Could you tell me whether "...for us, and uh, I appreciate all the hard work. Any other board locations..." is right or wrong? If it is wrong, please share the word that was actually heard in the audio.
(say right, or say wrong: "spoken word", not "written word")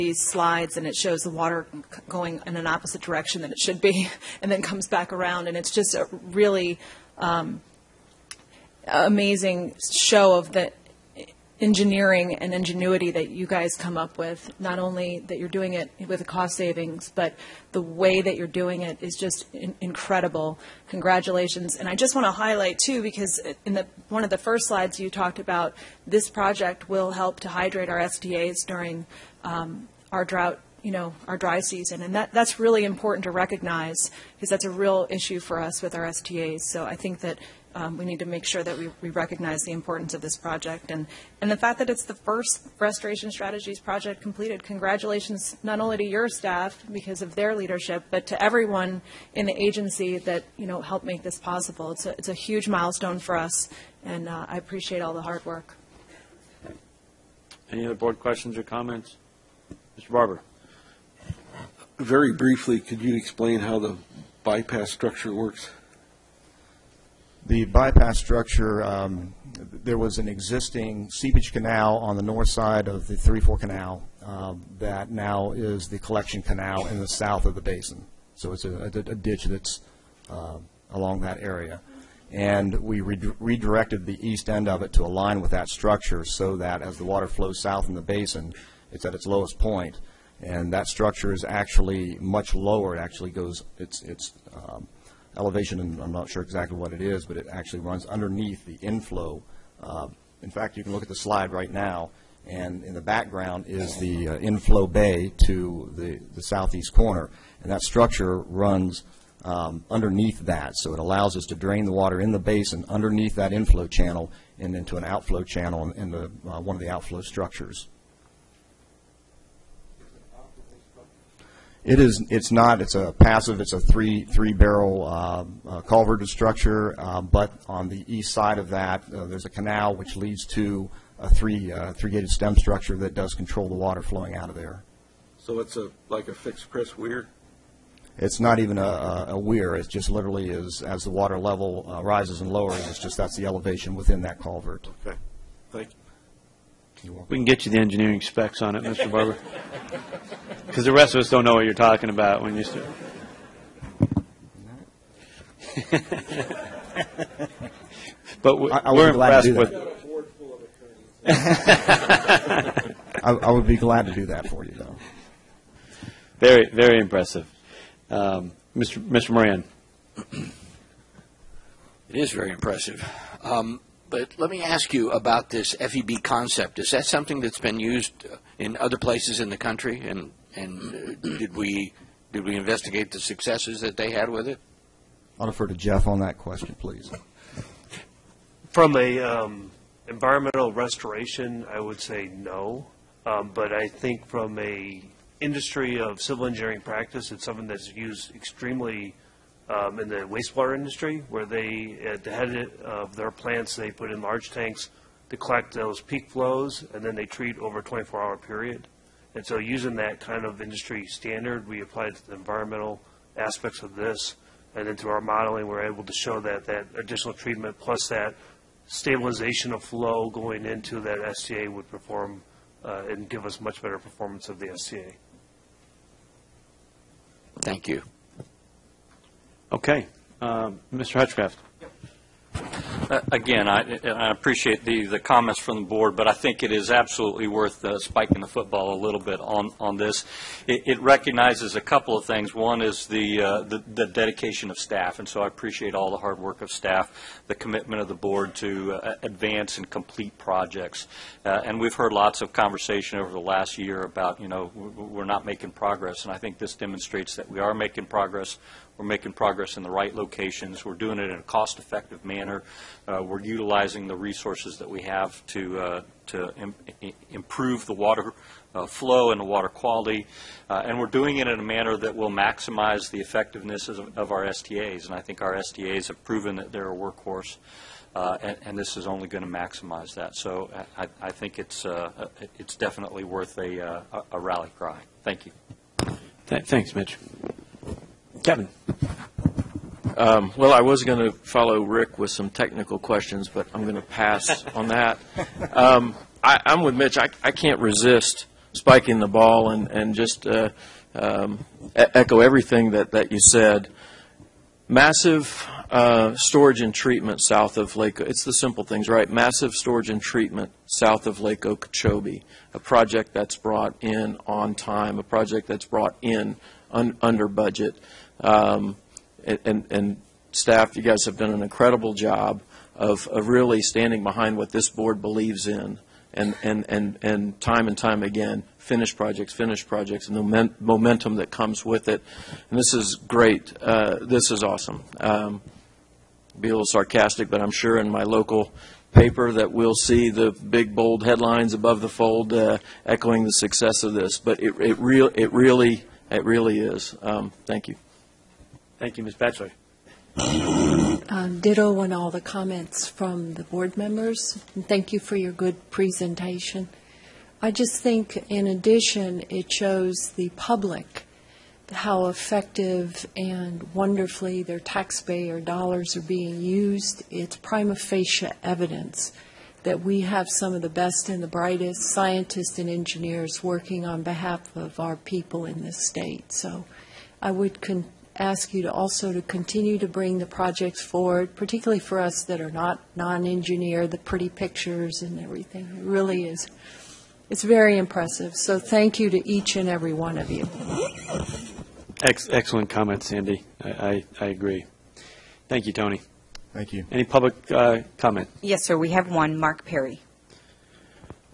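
wrong: "questions", not "locations".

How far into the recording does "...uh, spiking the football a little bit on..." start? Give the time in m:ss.
3:57.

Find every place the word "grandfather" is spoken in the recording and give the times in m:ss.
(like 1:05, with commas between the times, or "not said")
not said.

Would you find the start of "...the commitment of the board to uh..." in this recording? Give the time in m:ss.
4:07.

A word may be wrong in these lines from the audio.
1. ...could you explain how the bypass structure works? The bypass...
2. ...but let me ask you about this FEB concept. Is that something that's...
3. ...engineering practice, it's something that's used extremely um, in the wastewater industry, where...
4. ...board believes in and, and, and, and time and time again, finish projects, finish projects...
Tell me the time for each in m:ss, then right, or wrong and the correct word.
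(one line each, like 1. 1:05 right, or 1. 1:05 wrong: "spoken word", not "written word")
1. 1:02 right
2. 2:54 right
3. 3:16 right
4. 5:24 right.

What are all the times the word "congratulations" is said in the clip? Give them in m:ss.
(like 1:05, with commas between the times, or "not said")
0:20, 0:44.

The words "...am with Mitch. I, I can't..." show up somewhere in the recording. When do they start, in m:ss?
4:56.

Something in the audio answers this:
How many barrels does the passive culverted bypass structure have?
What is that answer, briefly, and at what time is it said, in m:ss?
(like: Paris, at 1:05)
3, at 2:04.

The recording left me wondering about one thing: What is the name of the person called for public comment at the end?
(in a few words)
Mark Perry.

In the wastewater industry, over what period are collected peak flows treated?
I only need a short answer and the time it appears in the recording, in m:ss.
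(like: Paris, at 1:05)
24 hours, at 3:27.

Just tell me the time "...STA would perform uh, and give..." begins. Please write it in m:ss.
3:41.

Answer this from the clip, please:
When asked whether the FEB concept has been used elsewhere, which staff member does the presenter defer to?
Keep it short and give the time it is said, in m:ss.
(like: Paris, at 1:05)
Jeff, at 3:05.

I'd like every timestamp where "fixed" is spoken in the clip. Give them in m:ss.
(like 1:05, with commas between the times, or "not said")
2:16.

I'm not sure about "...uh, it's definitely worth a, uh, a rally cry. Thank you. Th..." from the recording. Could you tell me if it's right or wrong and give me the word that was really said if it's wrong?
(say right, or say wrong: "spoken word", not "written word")
right.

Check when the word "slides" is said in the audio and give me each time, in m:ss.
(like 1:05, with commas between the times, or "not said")
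0:00, 0:24, 1:41.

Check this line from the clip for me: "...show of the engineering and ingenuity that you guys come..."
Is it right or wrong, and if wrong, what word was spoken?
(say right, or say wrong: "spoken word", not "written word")
right.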